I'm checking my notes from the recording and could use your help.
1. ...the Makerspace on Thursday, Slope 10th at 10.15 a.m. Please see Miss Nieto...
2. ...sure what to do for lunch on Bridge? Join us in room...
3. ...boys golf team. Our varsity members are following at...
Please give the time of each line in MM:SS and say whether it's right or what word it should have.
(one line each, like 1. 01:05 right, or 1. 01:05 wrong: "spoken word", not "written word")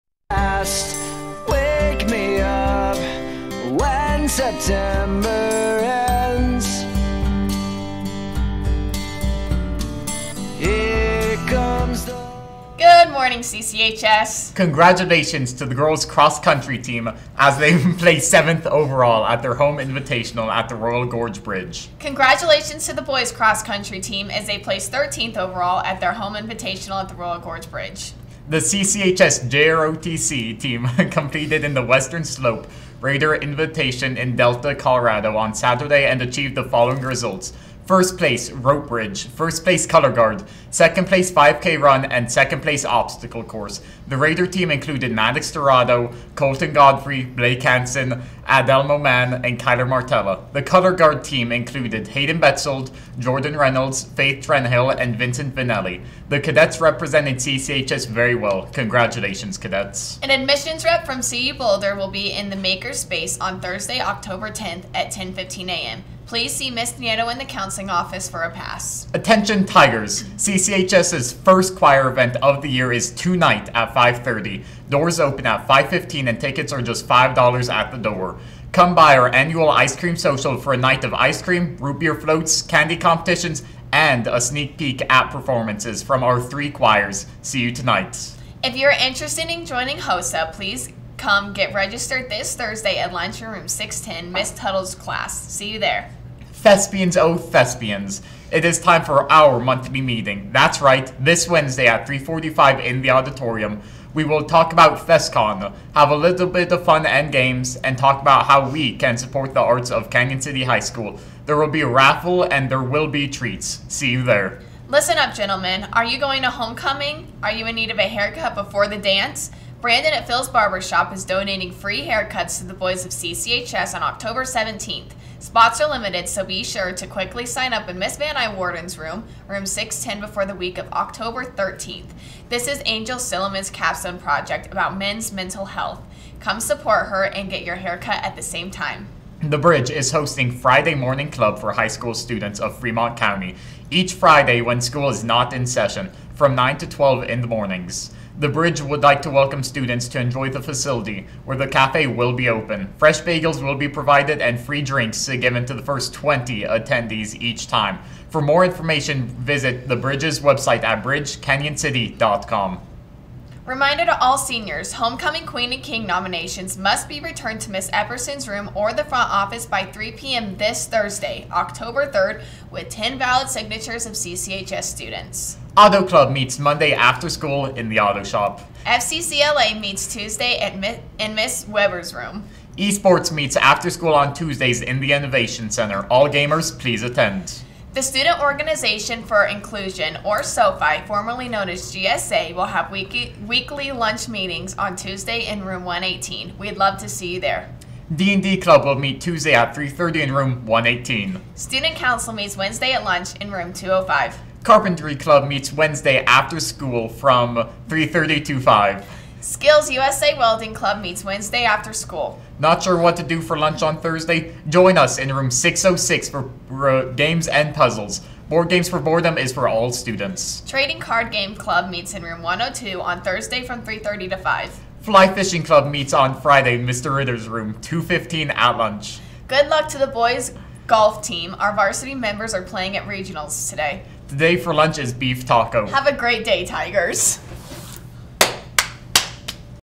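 1. 01:02 wrong: "October", not "Slope"
2. 03:32 wrong: "Thursday", not "Bridge"
3. 03:50 wrong: "playing", not "following".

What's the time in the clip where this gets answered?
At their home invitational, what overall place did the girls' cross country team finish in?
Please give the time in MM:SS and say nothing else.
00:18.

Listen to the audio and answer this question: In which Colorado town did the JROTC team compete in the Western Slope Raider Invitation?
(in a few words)
Delta.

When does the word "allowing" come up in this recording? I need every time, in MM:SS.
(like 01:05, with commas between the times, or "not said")
not said.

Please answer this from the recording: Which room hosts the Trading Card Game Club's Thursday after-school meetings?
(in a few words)
Room 102.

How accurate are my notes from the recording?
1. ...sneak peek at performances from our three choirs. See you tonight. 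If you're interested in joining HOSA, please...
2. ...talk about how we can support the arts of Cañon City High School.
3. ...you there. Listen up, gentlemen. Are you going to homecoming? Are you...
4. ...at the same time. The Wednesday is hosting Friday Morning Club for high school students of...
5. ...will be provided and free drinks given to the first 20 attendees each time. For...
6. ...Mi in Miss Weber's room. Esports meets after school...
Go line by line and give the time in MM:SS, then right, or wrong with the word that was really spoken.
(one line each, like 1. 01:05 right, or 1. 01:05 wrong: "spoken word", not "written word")
1. 01:24 right
2. 01:47 right
3. 01:54 right
4. 02:18 wrong: "Bridge", not "Wednesday"
5. 02:33 right
6. 03:00 right.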